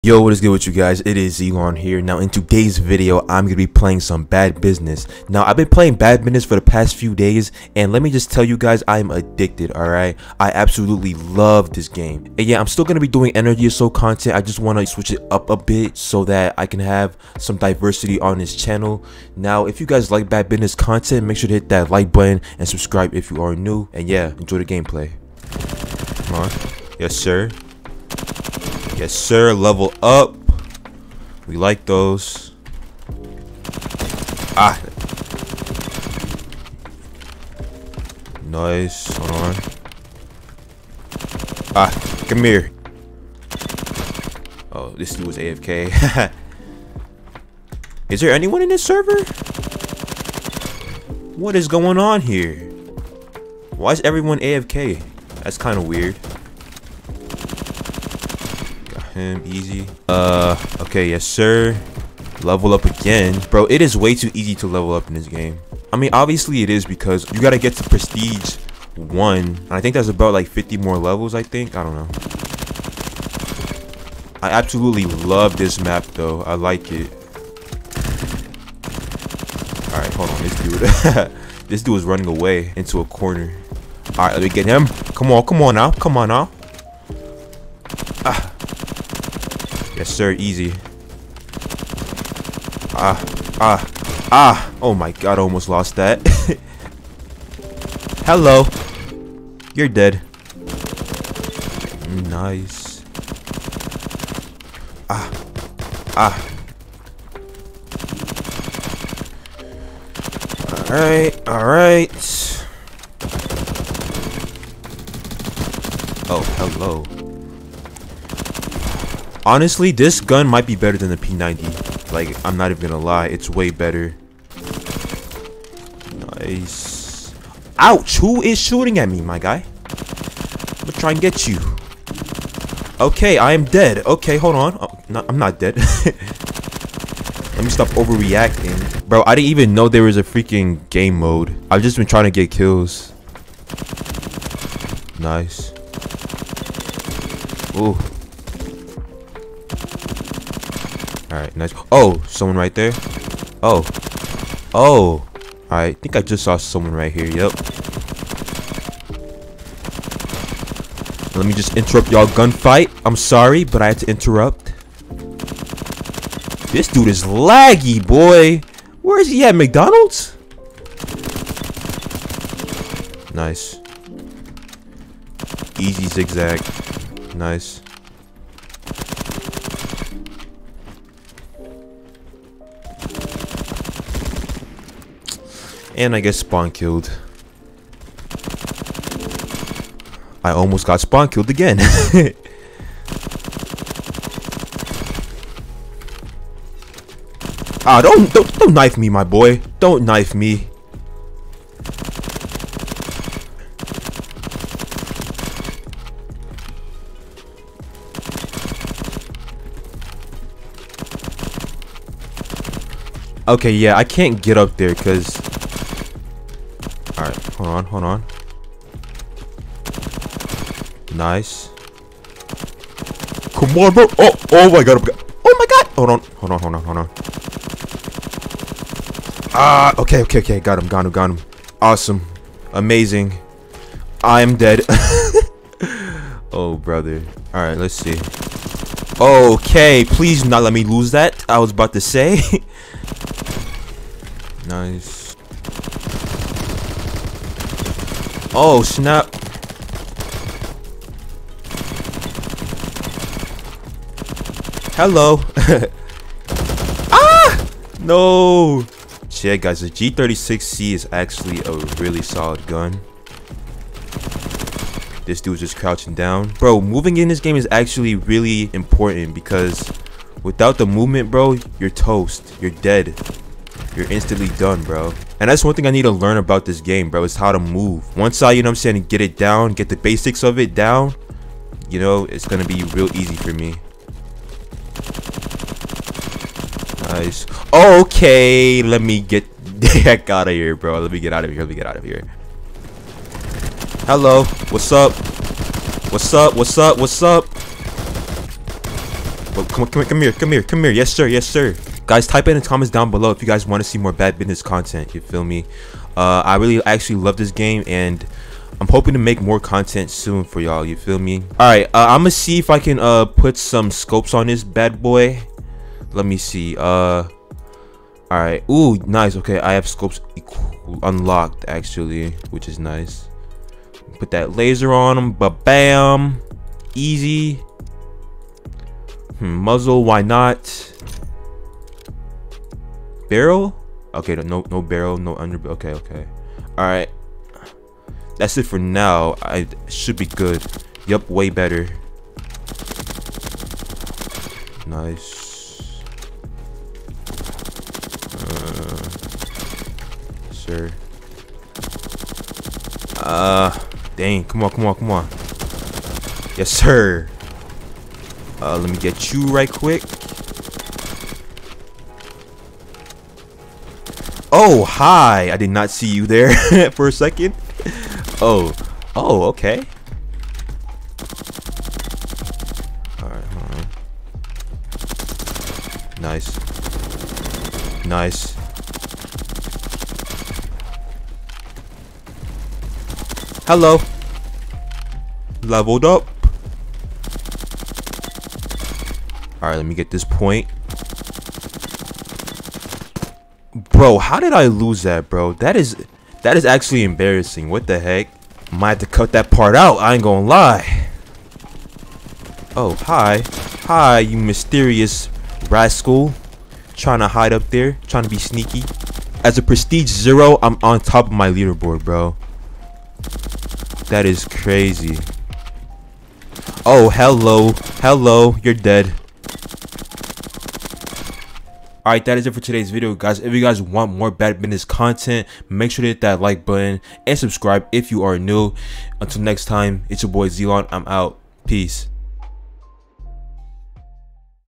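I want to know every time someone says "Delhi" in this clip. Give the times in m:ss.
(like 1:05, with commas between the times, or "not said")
not said.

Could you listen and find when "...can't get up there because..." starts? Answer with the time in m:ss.
3:34.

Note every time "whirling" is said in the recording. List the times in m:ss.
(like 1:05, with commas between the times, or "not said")
not said.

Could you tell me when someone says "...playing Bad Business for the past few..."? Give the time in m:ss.
0:05.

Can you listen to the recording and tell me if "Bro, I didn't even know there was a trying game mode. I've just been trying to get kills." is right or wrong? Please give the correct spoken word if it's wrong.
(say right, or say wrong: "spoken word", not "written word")
wrong: "freaking", not "trying".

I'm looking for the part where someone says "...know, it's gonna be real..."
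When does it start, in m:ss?
4:41.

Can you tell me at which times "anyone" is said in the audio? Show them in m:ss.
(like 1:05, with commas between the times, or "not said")
0:48.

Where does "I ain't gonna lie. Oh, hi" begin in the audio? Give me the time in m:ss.
6:39.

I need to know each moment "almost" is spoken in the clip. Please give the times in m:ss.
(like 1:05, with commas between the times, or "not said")
1:35, 3:10.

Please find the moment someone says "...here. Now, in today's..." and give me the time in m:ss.
0:01.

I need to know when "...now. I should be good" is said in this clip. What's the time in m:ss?
5:38.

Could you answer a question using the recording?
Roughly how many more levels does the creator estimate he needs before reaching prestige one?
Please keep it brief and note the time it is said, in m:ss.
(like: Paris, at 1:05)
50, at 1:10.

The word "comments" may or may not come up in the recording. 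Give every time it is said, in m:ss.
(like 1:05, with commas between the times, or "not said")
5:02.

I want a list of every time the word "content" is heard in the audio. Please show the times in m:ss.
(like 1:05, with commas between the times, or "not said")
0:13, 0:20, 5:04, 5:09, 7:04.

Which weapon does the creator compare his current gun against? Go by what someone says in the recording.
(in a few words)
P90.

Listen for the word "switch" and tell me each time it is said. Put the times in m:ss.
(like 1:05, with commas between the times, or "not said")
0:14.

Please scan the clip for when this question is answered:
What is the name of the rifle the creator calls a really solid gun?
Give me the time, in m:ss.
4:19.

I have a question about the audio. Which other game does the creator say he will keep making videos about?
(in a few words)
Energy Assault.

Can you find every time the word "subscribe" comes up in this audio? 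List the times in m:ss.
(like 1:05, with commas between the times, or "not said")
0:22, 7:07.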